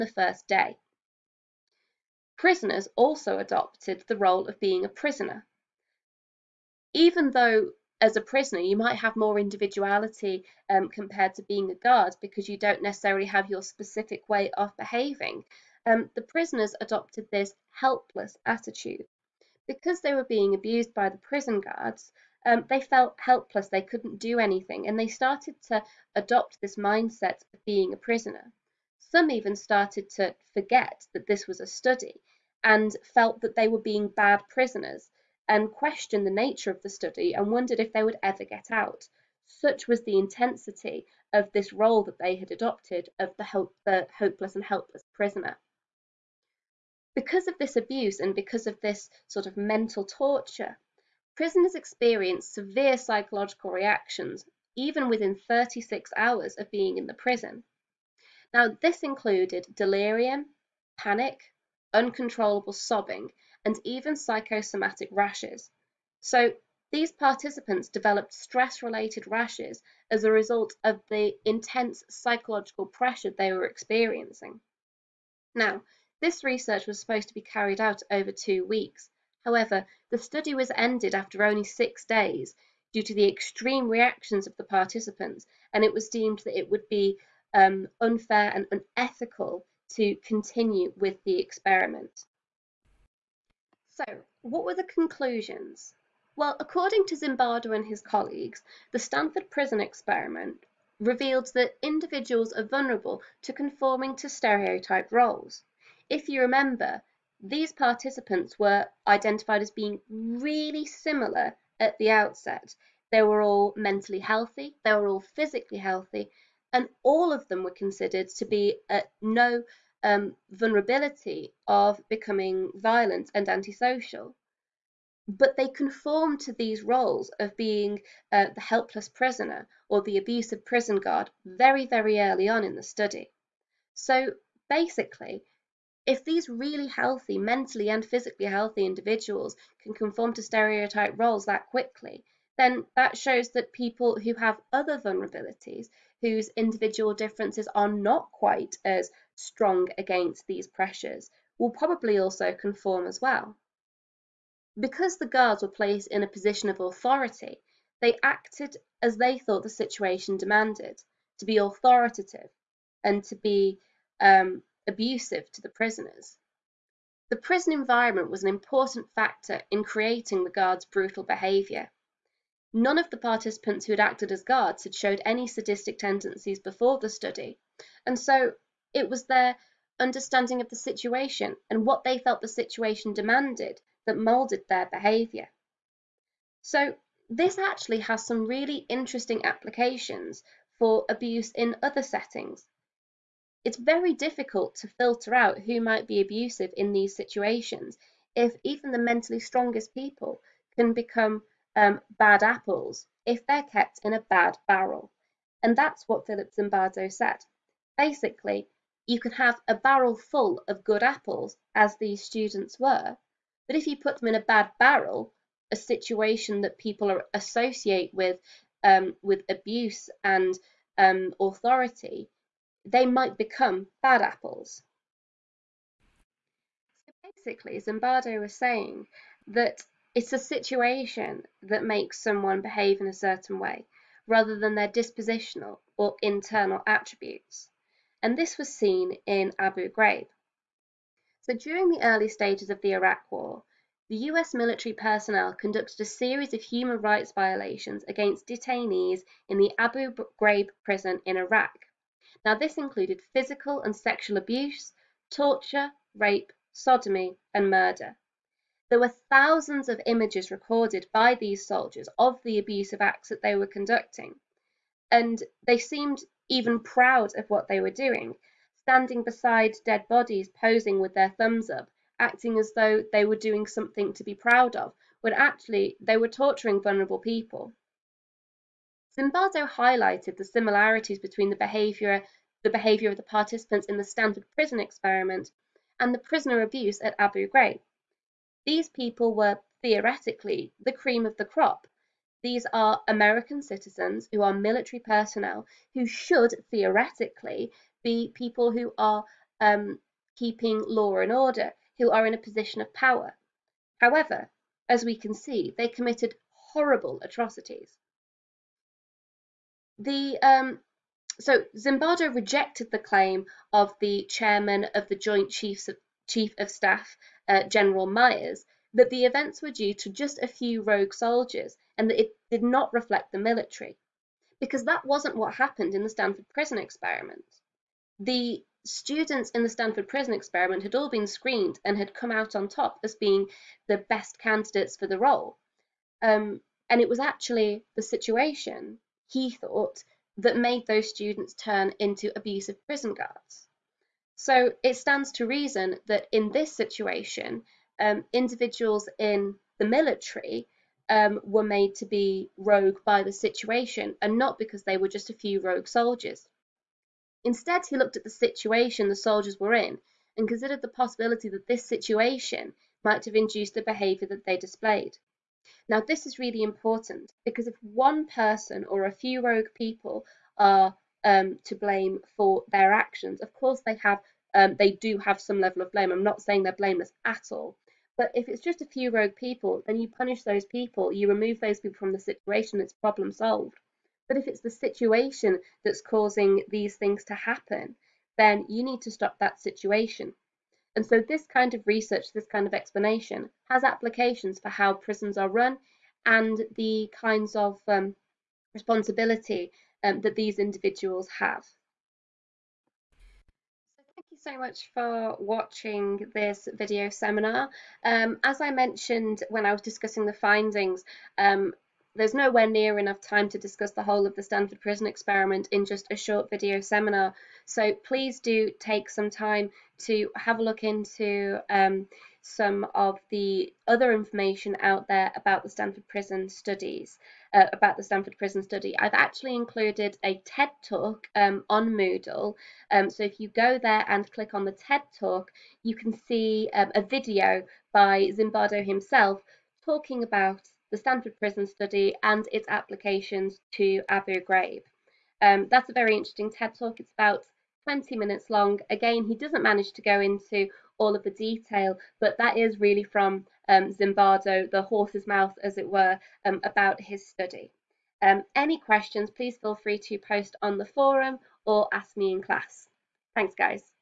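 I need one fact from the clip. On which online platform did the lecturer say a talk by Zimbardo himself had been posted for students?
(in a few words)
Moodle.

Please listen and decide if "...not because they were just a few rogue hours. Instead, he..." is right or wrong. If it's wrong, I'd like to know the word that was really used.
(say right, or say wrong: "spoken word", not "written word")
wrong: "soldiers", not "hours".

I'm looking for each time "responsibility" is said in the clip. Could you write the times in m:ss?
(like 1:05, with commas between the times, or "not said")
6:38.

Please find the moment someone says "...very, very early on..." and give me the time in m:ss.
2:11.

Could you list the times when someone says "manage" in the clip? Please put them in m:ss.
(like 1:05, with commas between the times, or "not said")
7:29.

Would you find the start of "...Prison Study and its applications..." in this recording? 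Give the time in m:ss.
7:21.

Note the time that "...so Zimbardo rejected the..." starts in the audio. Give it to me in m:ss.
5:11.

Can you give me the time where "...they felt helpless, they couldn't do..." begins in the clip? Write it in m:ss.
0:22.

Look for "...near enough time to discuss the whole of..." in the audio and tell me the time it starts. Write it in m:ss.
6:52.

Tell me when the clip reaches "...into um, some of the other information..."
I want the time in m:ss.
7:00.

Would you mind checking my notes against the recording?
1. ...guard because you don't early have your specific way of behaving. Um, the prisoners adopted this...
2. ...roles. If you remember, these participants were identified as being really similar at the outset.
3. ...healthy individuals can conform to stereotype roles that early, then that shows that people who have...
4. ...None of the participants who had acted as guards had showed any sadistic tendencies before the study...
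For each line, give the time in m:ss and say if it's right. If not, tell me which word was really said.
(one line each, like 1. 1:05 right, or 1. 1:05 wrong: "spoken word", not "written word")
1. 0:11 wrong: "necessarily", not "early"
2. 1:45 right
3. 2:18 wrong: "quickly", not "early"
4. 2:52 right.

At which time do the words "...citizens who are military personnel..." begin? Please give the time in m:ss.
4:53.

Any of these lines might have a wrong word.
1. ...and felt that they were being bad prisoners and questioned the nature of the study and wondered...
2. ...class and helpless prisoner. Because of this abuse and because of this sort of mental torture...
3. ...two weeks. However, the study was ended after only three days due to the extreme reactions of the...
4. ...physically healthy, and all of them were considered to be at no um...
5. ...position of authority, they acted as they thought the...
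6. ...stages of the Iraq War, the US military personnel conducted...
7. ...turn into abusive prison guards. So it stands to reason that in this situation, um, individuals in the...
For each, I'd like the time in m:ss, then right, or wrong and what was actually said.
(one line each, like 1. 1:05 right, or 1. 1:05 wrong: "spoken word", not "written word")
1. 0:32 right
2. 0:44 wrong: "hopeless", not "class"
3. 1:18 wrong: "six", not "three"
4. 1:55 right
5. 2:36 right
6. 4:02 right
7. 5:41 right.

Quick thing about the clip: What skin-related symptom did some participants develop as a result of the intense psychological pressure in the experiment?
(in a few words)
psychosomatic rashes.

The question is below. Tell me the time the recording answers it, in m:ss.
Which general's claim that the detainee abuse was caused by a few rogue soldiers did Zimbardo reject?
5:17.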